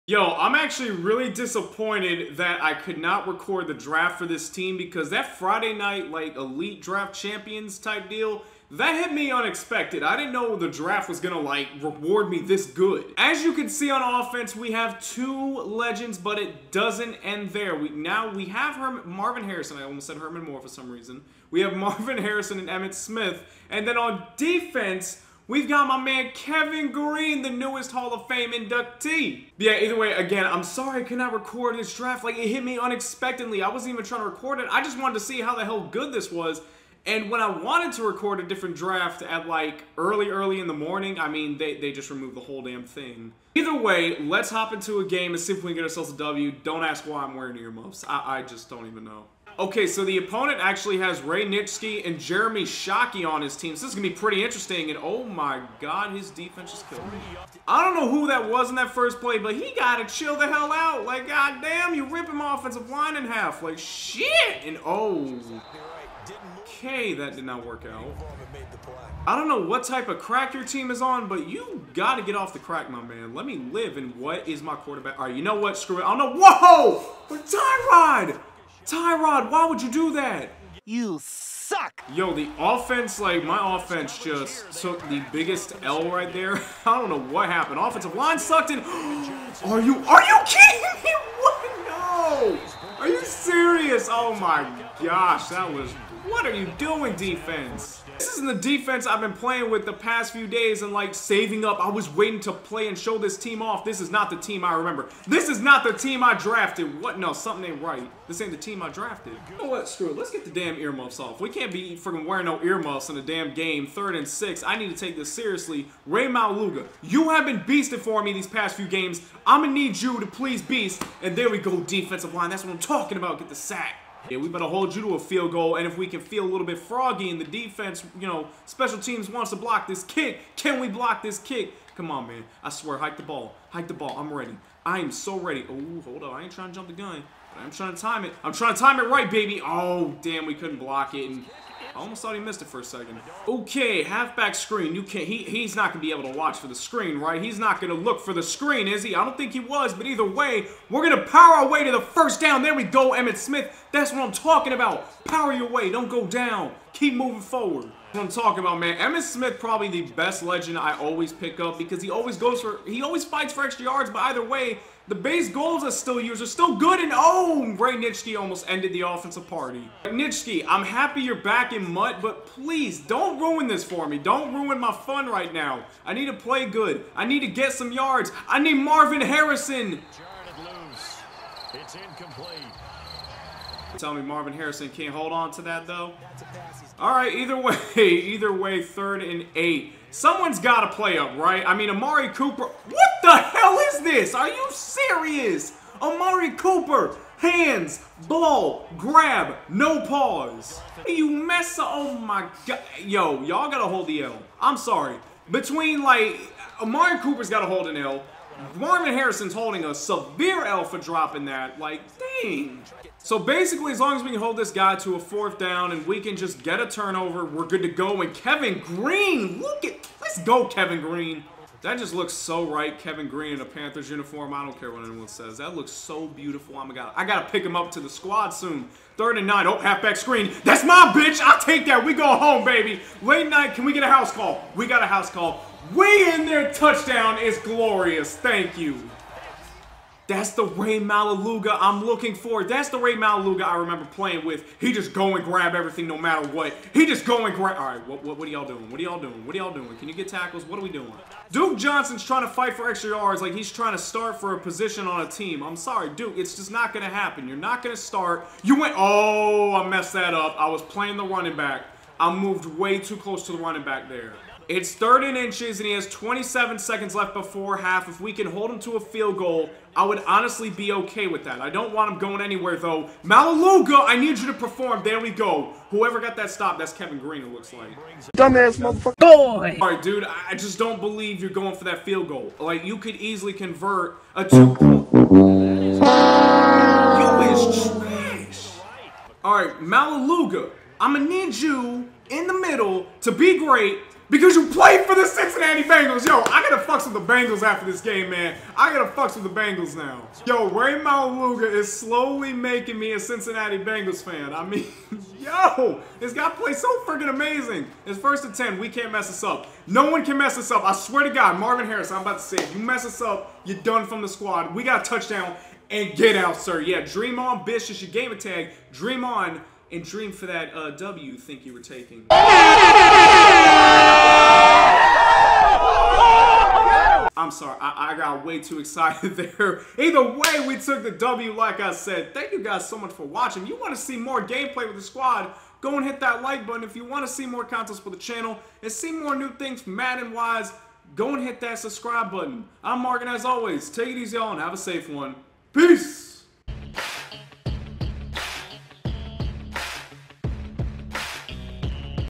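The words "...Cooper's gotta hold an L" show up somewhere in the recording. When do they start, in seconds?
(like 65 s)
207 s.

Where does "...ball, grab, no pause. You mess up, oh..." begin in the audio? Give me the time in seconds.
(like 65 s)
198 s.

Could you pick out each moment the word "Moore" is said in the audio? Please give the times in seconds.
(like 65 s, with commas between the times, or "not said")
20 s.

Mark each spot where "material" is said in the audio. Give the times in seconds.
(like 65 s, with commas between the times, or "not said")
not said.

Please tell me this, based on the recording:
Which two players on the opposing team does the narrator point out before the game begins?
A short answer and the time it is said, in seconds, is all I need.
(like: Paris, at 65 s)
Ray Nitschke and Jeremy Shockey, at 51 s.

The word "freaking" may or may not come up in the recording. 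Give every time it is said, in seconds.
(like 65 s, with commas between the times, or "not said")
111 s, 307 s.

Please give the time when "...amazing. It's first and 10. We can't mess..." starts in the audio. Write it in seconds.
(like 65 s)
307 s.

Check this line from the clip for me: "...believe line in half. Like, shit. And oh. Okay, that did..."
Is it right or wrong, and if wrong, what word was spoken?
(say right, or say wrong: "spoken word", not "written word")
wrong: "offensive", not "believe".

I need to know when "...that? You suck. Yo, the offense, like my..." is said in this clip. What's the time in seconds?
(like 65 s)
80 s.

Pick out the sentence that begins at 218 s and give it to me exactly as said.
And Kevin Greene, look at, let's go Kevin Greene.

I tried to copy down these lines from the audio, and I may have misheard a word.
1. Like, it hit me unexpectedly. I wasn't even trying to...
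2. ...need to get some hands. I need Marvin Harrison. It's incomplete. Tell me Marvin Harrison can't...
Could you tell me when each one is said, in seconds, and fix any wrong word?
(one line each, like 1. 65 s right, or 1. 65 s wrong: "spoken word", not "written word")
1. 32 s right
2. 177 s wrong: "yards", not "hands".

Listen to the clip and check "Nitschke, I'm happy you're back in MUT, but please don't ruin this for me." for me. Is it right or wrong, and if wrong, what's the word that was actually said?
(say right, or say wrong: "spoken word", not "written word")
right.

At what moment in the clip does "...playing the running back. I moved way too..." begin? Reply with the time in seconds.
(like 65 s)
260 s.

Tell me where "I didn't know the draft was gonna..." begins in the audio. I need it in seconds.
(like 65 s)
10 s.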